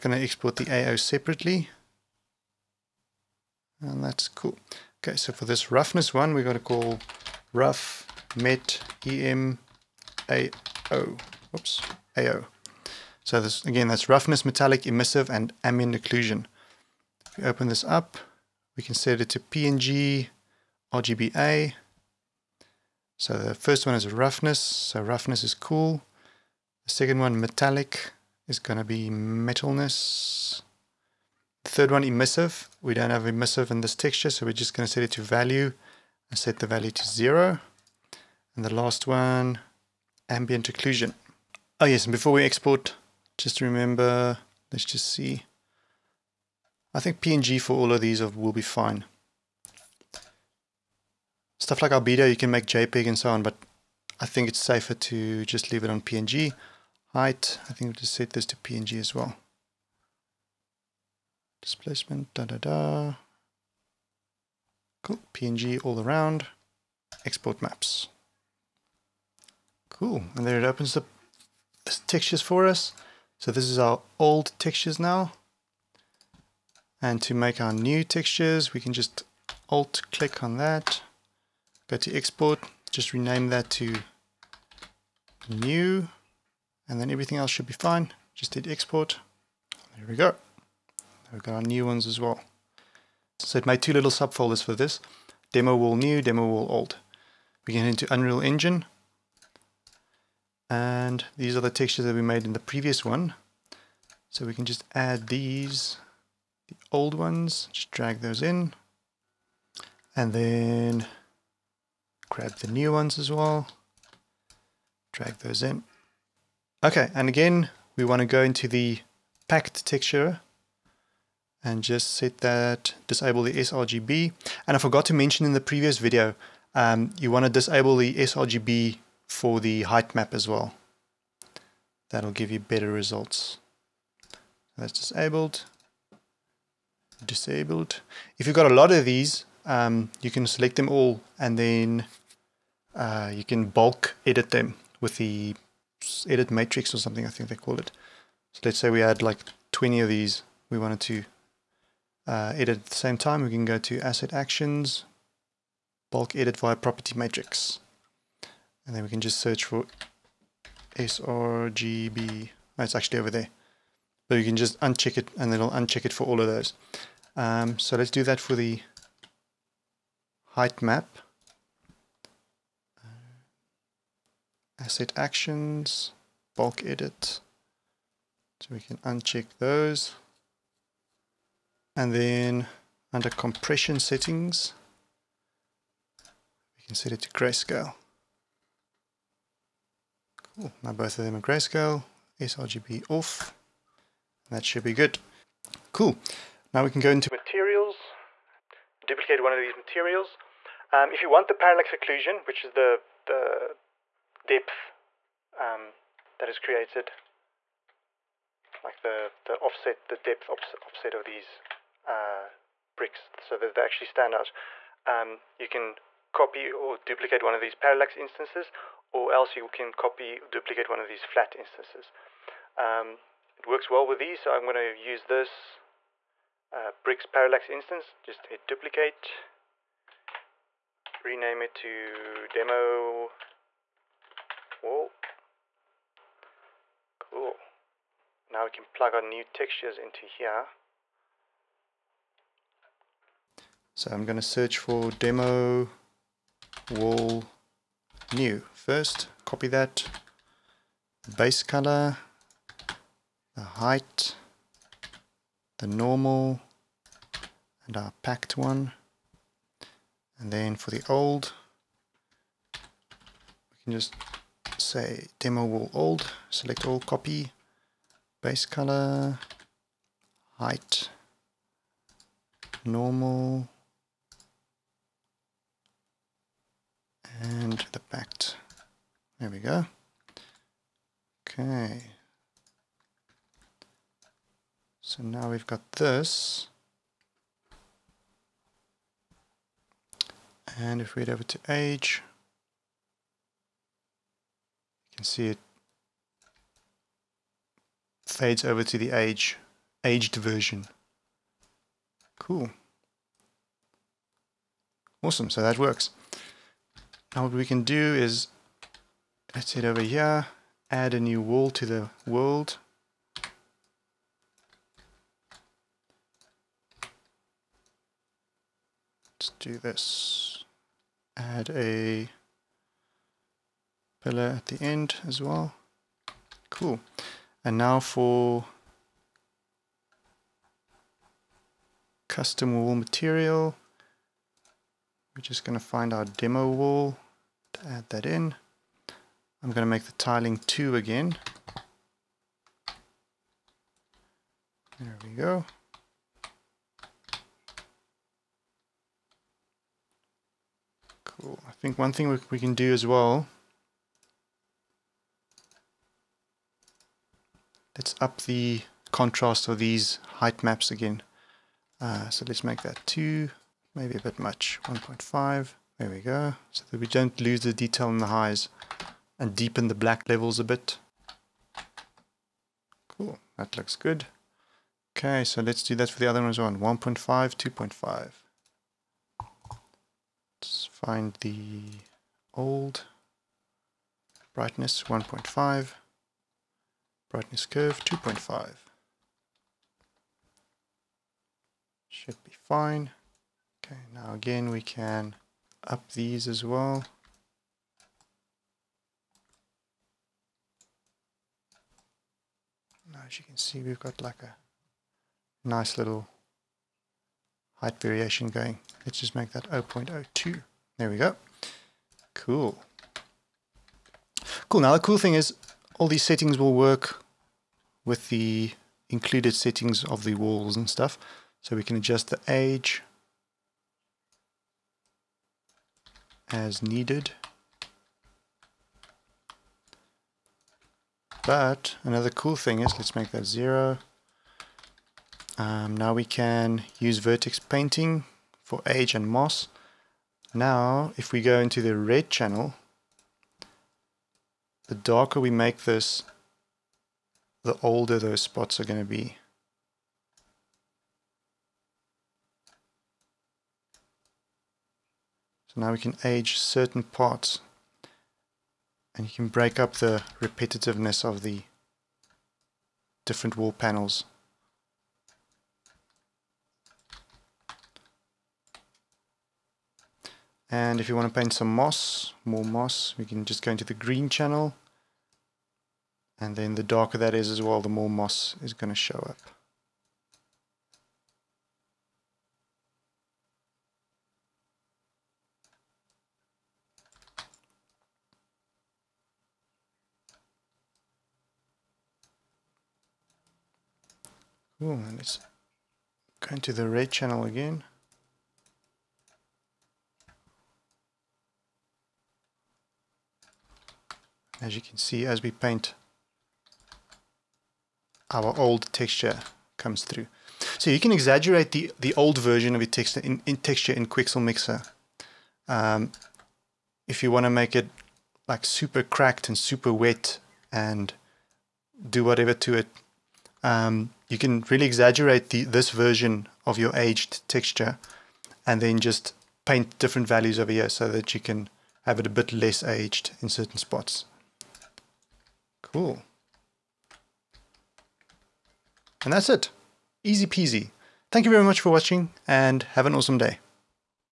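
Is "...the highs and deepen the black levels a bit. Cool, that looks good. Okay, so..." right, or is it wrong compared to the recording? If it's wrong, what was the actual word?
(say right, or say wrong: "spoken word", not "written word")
right.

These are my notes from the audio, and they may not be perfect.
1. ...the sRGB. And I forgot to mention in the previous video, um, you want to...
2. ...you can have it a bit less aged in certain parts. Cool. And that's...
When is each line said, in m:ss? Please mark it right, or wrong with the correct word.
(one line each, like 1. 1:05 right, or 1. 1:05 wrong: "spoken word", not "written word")
1. 2:03 right
2. 8:51 wrong: "spots", not "parts".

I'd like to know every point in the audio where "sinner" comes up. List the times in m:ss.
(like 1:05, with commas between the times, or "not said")
not said.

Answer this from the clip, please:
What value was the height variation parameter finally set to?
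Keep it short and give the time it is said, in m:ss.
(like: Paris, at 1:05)
0.02, at 6:49.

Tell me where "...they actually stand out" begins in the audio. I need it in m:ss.
3:33.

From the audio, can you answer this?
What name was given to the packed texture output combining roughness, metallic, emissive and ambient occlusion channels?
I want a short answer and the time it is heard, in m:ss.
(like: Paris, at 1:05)
rough met em AO, at 0:07.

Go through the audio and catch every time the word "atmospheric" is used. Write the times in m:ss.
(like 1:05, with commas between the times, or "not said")
not said.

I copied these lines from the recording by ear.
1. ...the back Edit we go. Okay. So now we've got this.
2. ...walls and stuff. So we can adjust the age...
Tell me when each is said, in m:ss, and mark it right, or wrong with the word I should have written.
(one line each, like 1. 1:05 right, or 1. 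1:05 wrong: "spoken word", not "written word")
1. 4:37 wrong: "There", not "Edit"
2. 7:00 right.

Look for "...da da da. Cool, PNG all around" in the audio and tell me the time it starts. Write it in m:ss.
1:02.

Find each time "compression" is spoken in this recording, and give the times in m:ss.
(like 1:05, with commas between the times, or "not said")
3:03.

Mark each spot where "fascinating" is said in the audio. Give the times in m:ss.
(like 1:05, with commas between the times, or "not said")
not said.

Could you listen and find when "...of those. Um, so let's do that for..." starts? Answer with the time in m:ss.
2:46.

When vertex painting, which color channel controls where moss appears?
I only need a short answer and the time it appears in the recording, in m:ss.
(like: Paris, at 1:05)
green, at 7:53.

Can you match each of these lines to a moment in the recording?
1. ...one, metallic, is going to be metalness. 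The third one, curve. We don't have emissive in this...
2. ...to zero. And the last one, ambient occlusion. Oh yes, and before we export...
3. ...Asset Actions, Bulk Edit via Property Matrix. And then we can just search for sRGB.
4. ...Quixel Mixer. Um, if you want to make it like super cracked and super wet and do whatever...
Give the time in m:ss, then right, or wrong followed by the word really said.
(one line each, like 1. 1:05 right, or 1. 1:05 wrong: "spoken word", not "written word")
1. 0:27 wrong: "emissive", not "curve"
2. 0:36 right
3. 2:33 right
4. 8:34 right.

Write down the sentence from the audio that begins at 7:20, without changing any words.
Now, if we go into the red channel, the darker we make this, the older those spots are going to be.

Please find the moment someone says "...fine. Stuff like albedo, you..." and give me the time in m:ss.
0:48.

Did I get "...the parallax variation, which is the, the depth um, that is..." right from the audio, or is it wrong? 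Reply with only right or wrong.
wrong.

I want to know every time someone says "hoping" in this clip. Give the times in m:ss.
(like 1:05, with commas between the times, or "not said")
not said.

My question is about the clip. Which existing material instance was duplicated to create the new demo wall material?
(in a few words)
bricks parallax instance.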